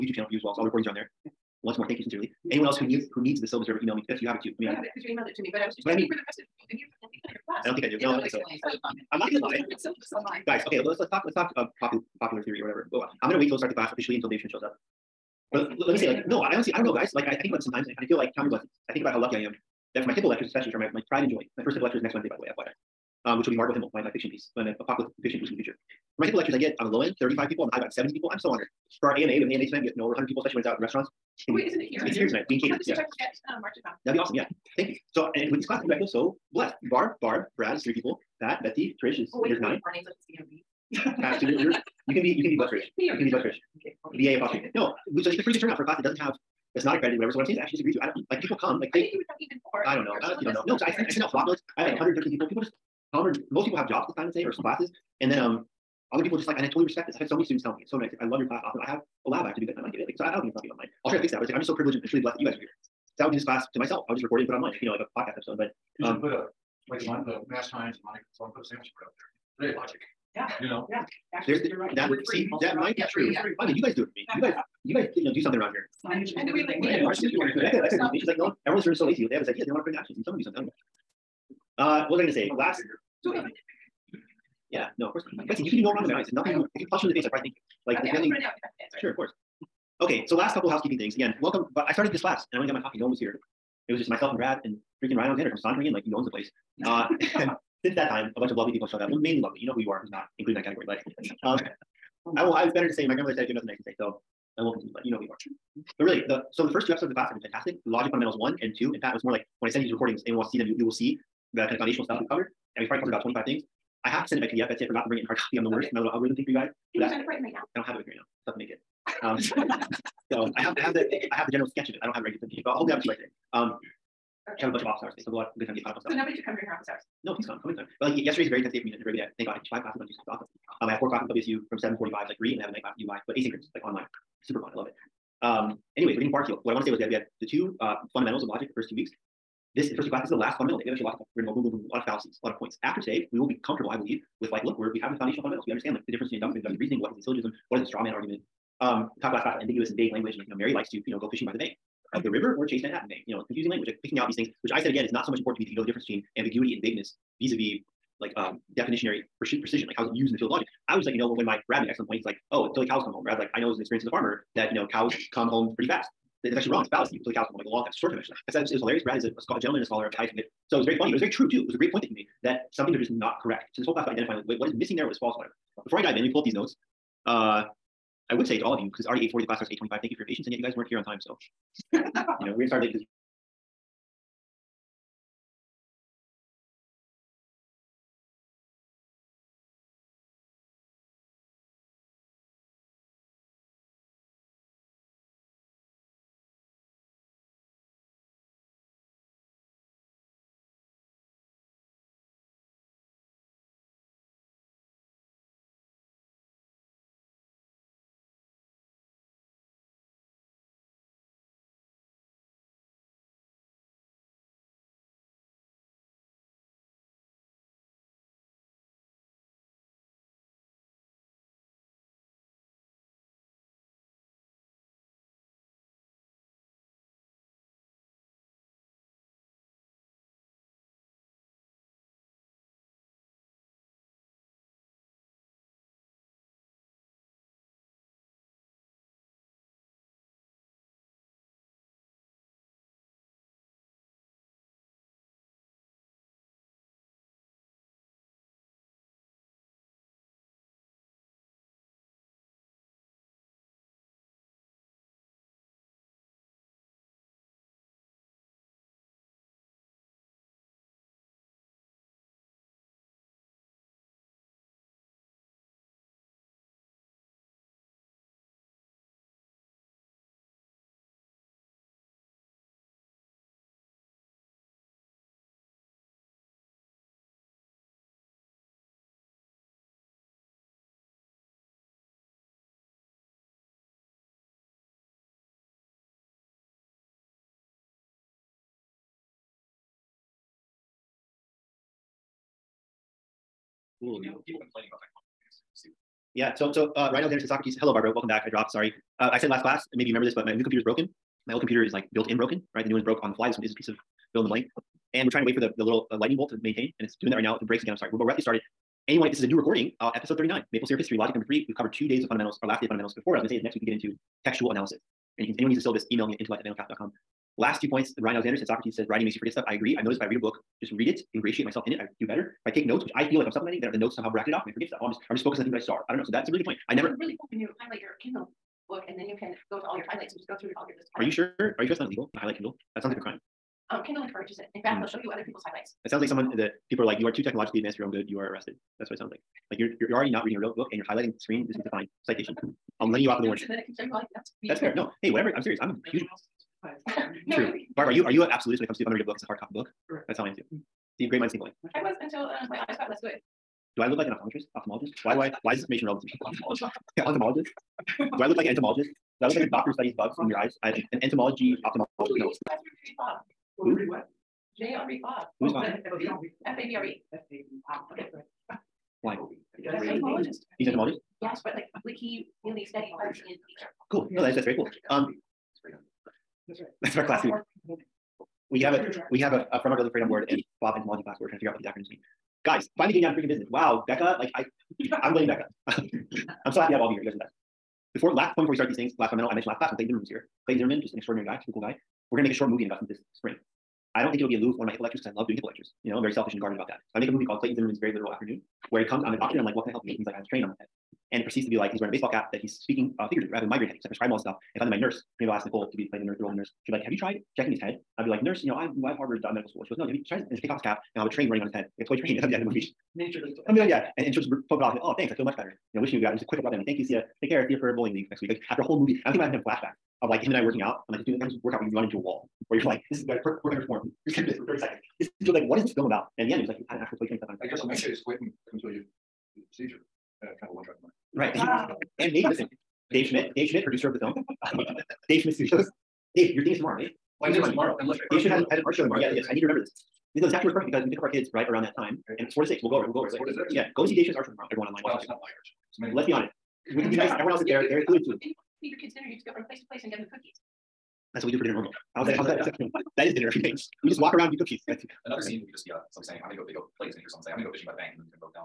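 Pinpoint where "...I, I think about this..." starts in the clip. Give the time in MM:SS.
00:17.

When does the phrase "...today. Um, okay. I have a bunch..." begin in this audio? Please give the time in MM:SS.
02:03.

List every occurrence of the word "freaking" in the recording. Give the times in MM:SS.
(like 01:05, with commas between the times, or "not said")
01:35, 06:23.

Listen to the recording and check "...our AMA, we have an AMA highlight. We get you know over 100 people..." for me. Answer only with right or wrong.
wrong.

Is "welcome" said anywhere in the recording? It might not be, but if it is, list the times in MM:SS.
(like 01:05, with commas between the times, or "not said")
01:31, 04:58.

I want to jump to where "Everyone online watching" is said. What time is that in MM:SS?
07:24.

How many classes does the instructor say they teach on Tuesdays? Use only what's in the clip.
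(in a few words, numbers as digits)
5.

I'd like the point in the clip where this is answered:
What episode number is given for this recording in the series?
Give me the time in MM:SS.
05:10.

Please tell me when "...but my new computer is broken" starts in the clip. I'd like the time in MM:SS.
05:00.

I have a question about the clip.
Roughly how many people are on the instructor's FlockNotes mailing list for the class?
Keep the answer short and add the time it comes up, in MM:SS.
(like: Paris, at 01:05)
113, at 00:51.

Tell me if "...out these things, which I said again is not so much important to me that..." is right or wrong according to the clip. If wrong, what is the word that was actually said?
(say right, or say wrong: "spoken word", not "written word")
right.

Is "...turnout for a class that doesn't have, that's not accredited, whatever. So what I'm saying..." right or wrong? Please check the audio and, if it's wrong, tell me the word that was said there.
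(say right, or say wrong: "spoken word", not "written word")
right.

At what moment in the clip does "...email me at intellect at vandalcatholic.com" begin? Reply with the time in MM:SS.
05:16.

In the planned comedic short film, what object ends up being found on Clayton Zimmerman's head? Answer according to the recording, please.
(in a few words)
toy train.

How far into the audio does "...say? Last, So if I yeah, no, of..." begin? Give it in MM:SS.
01:22.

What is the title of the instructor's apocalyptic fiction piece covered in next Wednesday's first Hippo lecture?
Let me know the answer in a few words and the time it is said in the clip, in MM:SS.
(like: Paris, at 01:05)
Margot Himmel, at 00:23.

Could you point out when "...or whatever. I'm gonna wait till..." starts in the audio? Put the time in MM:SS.
00:12.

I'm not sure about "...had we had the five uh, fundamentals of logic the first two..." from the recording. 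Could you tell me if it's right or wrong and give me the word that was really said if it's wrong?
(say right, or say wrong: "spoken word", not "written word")
wrong: "two", not "five".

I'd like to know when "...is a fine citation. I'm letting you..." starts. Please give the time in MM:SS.
05:41.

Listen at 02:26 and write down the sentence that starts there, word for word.
reasoning, what is a syllogism, what is a straw man argument.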